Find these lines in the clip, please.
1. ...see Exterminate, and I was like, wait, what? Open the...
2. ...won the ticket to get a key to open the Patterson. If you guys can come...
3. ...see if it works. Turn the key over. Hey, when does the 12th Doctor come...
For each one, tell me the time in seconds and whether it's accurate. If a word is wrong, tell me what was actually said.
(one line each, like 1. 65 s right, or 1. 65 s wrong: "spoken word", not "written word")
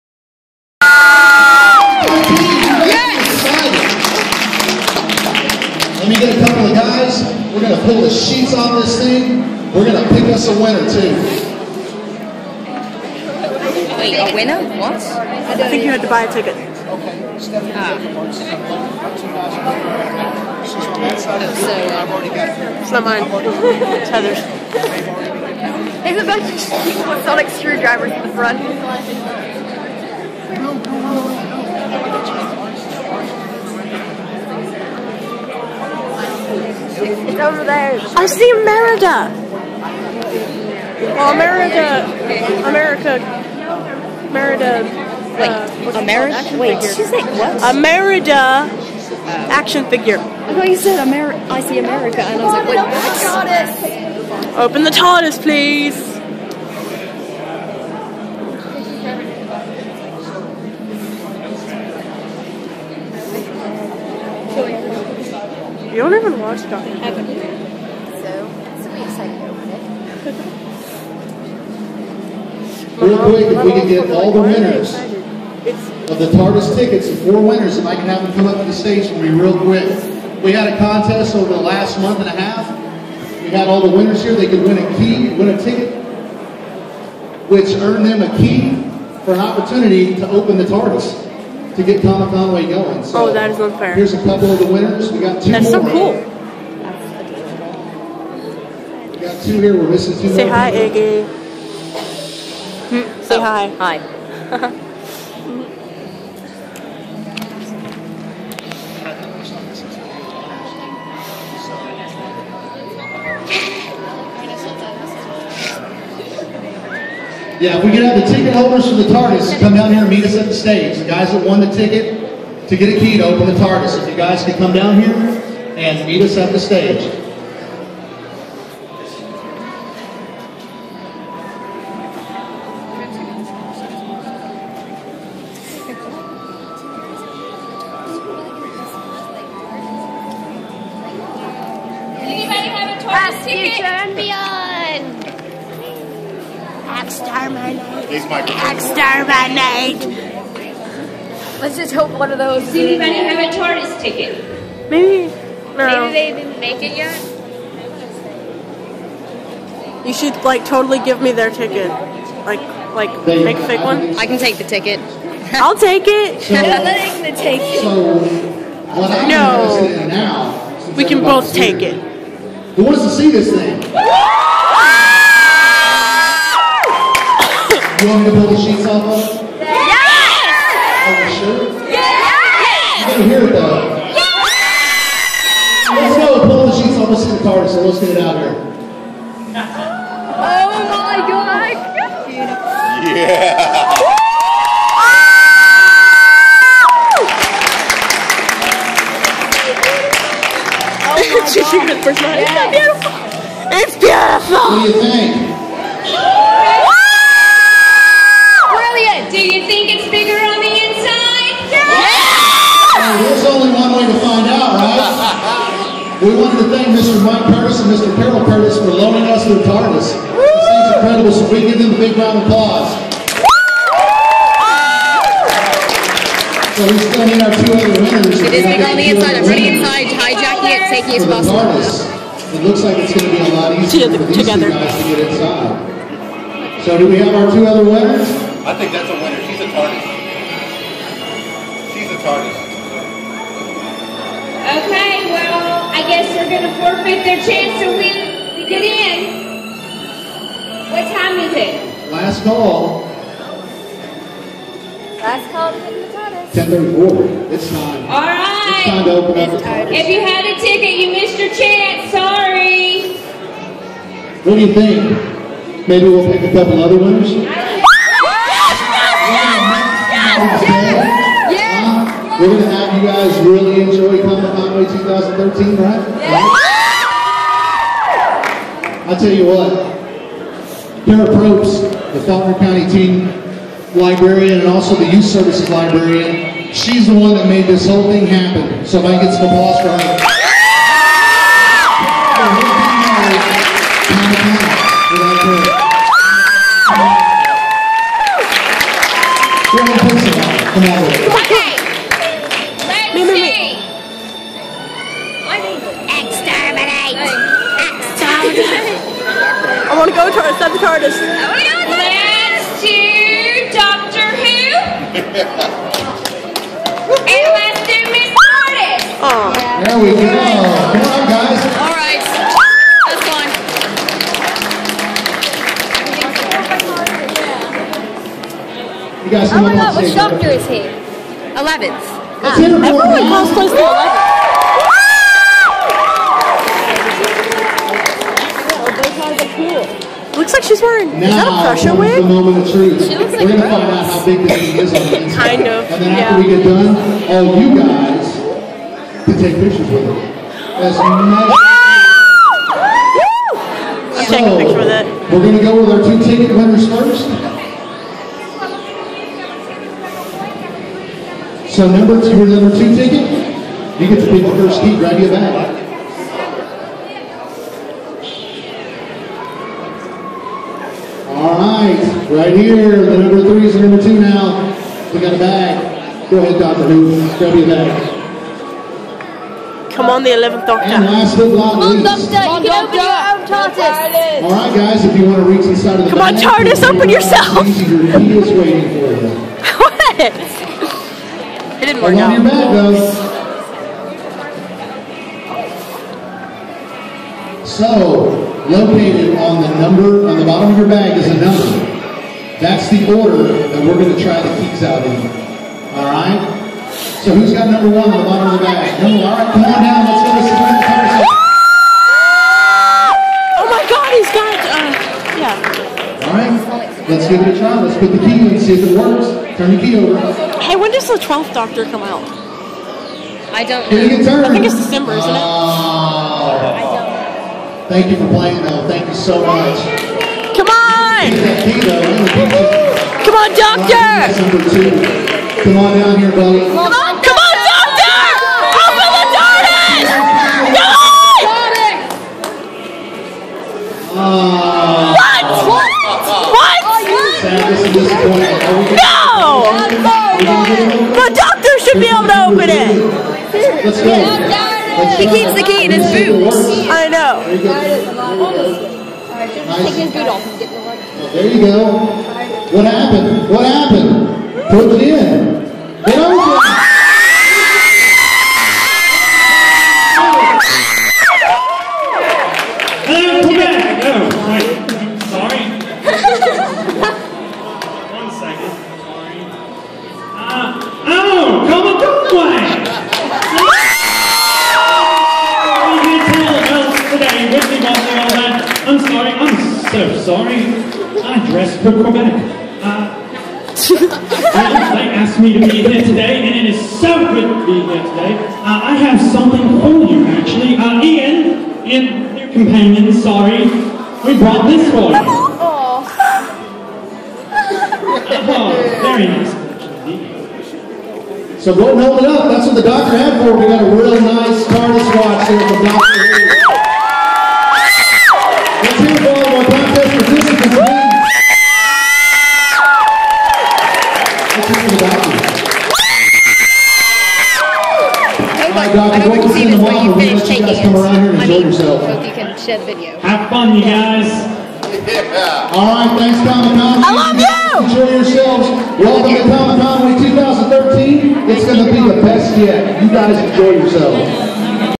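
1. 51 s wrong: "America", not "Exterminate"
2. 121 s wrong: "TARDIS", not "Patterson"
3. 418 s right.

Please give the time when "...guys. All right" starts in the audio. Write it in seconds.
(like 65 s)
321 s.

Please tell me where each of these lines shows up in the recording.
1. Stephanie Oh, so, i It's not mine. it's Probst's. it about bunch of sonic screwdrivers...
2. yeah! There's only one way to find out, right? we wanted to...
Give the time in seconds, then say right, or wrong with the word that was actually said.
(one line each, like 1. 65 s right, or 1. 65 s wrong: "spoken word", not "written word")
1. 17 s wrong: "Heather", not "Probst"
2. 211 s right.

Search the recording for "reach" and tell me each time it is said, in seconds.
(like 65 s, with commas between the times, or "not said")
385 s.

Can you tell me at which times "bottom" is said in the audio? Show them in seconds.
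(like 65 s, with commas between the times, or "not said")
400 s, 408 s.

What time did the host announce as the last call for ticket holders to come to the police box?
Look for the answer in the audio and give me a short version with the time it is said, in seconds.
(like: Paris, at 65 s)
10:34, at 256 s.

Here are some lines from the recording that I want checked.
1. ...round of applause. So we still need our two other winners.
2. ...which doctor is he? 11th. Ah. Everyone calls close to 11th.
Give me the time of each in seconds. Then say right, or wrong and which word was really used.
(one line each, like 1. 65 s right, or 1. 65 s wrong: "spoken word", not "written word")
1. 222 s right
2. 330 s right.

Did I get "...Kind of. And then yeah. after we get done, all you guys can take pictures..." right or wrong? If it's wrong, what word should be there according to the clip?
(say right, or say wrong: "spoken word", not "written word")
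right.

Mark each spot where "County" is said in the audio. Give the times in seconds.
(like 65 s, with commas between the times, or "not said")
282 s.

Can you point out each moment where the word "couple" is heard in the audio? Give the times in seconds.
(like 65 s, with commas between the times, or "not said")
94 s, 266 s.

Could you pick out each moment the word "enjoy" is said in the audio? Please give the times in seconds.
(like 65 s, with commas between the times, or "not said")
273 s, 537 s, 543 s.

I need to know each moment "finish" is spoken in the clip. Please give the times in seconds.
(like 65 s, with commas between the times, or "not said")
530 s.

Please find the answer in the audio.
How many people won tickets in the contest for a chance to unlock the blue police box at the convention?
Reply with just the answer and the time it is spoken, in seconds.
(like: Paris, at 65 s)
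4, at 77 s.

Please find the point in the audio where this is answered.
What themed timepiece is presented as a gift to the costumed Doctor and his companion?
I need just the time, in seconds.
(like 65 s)
514 s.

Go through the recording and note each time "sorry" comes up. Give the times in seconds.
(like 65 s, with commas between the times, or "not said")
262 s, 503 s.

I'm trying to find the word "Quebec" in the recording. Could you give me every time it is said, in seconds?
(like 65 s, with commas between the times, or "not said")
492 s.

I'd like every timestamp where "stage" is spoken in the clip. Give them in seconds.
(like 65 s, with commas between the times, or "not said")
78 s, 120 s, 126 s.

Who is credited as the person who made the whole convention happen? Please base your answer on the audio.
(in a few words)
Kara Probst.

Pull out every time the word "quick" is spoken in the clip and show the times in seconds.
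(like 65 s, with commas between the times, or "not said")
73 s, 79 s.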